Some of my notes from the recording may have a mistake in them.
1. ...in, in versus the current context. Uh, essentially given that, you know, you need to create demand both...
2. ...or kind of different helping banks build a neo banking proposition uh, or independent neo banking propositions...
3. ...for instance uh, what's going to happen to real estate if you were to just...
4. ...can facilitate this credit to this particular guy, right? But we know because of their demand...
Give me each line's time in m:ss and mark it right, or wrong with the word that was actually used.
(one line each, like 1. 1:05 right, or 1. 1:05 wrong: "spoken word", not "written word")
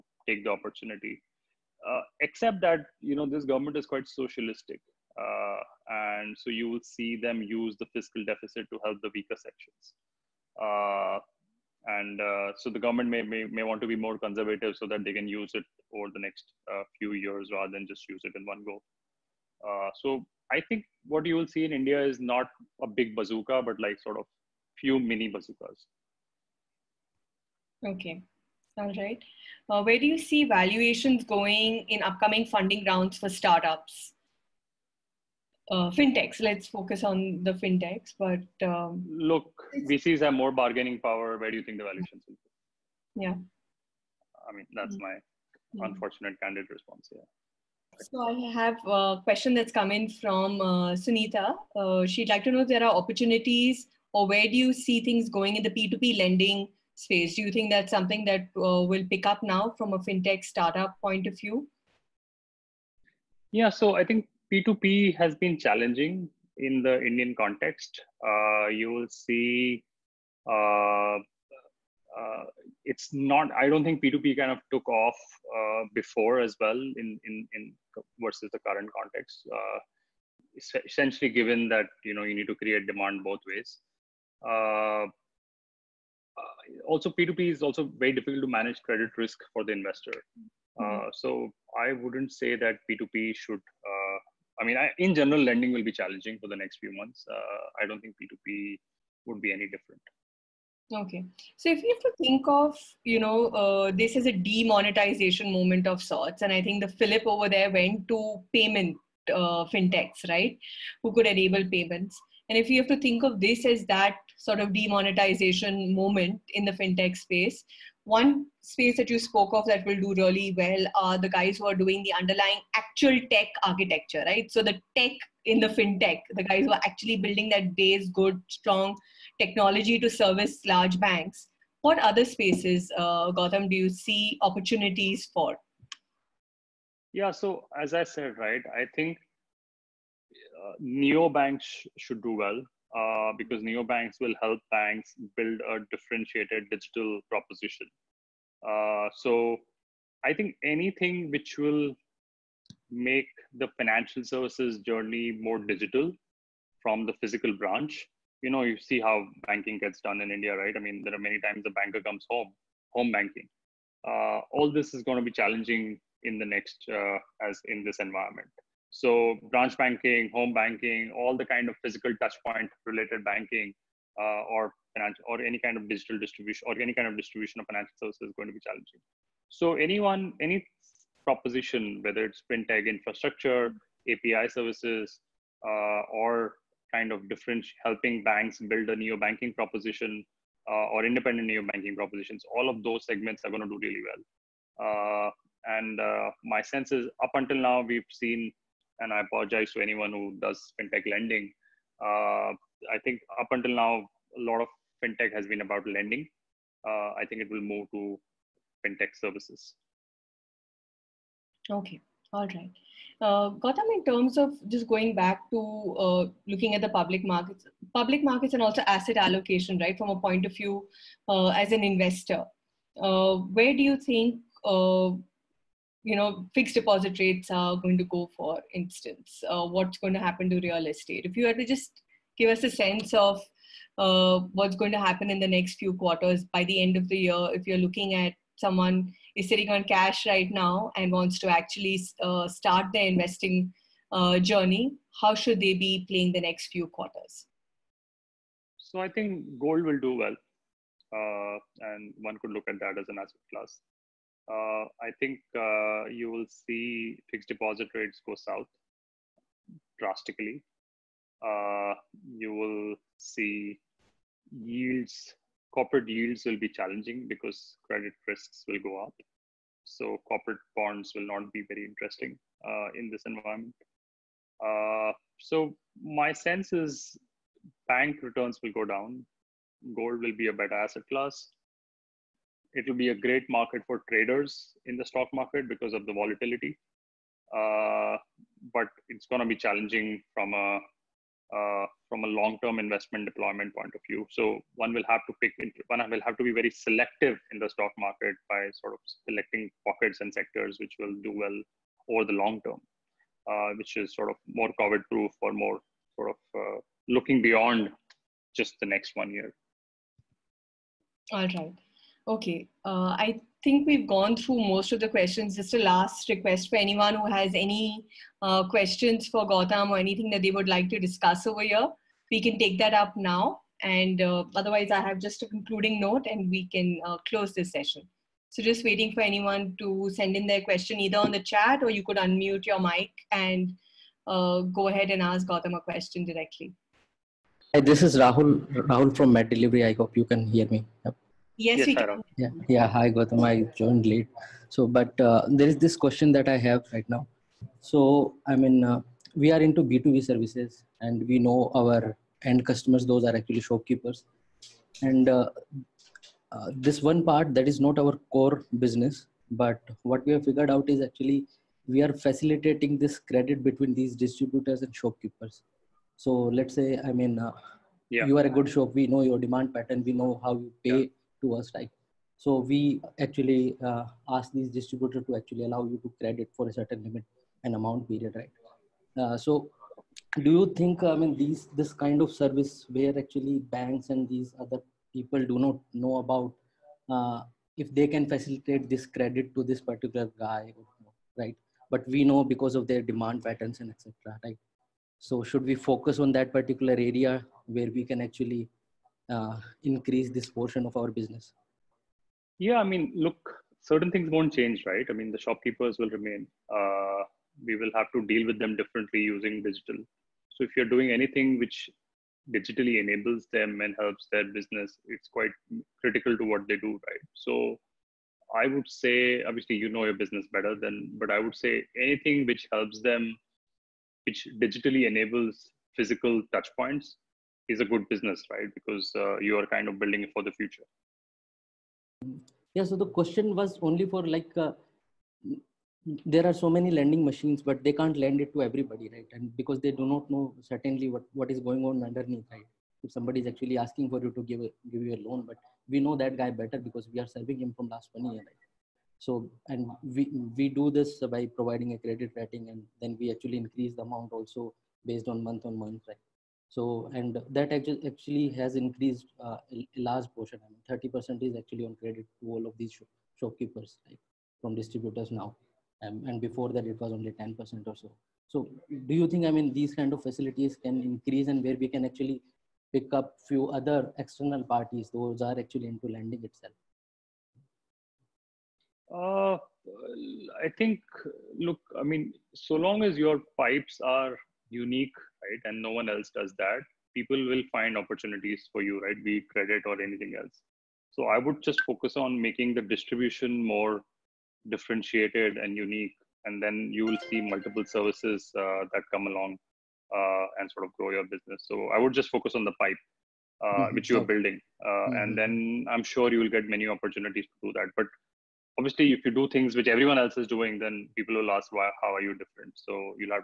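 1. 1:17 right
2. 3:06 right
3. 3:48 right
4. 6:28 right.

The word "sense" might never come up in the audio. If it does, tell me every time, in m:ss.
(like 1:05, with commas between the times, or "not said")
3:16, 3:52, 4:36.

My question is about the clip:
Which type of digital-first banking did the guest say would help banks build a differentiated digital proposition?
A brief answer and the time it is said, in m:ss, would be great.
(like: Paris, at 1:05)
neo banks, at 2:20.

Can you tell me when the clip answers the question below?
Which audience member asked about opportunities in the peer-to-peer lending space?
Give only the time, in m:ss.
0:50.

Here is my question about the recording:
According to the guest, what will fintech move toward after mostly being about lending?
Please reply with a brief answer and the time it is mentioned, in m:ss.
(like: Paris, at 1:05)
fintech services, at 3:28.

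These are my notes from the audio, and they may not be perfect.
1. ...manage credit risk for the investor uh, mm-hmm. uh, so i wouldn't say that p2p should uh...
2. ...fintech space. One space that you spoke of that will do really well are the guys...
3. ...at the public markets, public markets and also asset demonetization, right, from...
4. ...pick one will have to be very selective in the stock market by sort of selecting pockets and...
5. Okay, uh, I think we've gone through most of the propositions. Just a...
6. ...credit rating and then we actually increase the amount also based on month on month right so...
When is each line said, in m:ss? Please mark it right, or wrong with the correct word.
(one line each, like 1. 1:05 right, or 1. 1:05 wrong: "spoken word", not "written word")
1. 1:28 right
2. 1:56 right
3. 3:36 wrong: "allocation", not "demonetization"
4. 4:55 right
5. 5:12 wrong: "questions", not "propositions"
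6. 7:31 right.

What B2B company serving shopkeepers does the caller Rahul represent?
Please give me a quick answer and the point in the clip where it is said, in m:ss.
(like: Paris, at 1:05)
Med Delivery, at 5:39.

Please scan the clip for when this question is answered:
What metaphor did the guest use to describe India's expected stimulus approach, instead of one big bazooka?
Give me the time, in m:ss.
0:24.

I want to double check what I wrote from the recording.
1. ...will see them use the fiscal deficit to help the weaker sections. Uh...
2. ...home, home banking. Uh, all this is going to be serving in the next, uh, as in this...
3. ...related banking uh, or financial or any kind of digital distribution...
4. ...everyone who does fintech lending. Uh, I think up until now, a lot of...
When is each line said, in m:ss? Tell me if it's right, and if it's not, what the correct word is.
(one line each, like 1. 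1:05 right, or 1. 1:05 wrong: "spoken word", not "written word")
1. 0:06 right
2. 2:42 wrong: "challenging", not "serving"
3. 2:52 right
4. 3:19 wrong: "anyone", not "everyone".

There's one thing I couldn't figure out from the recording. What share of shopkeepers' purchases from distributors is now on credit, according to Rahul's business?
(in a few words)
30%.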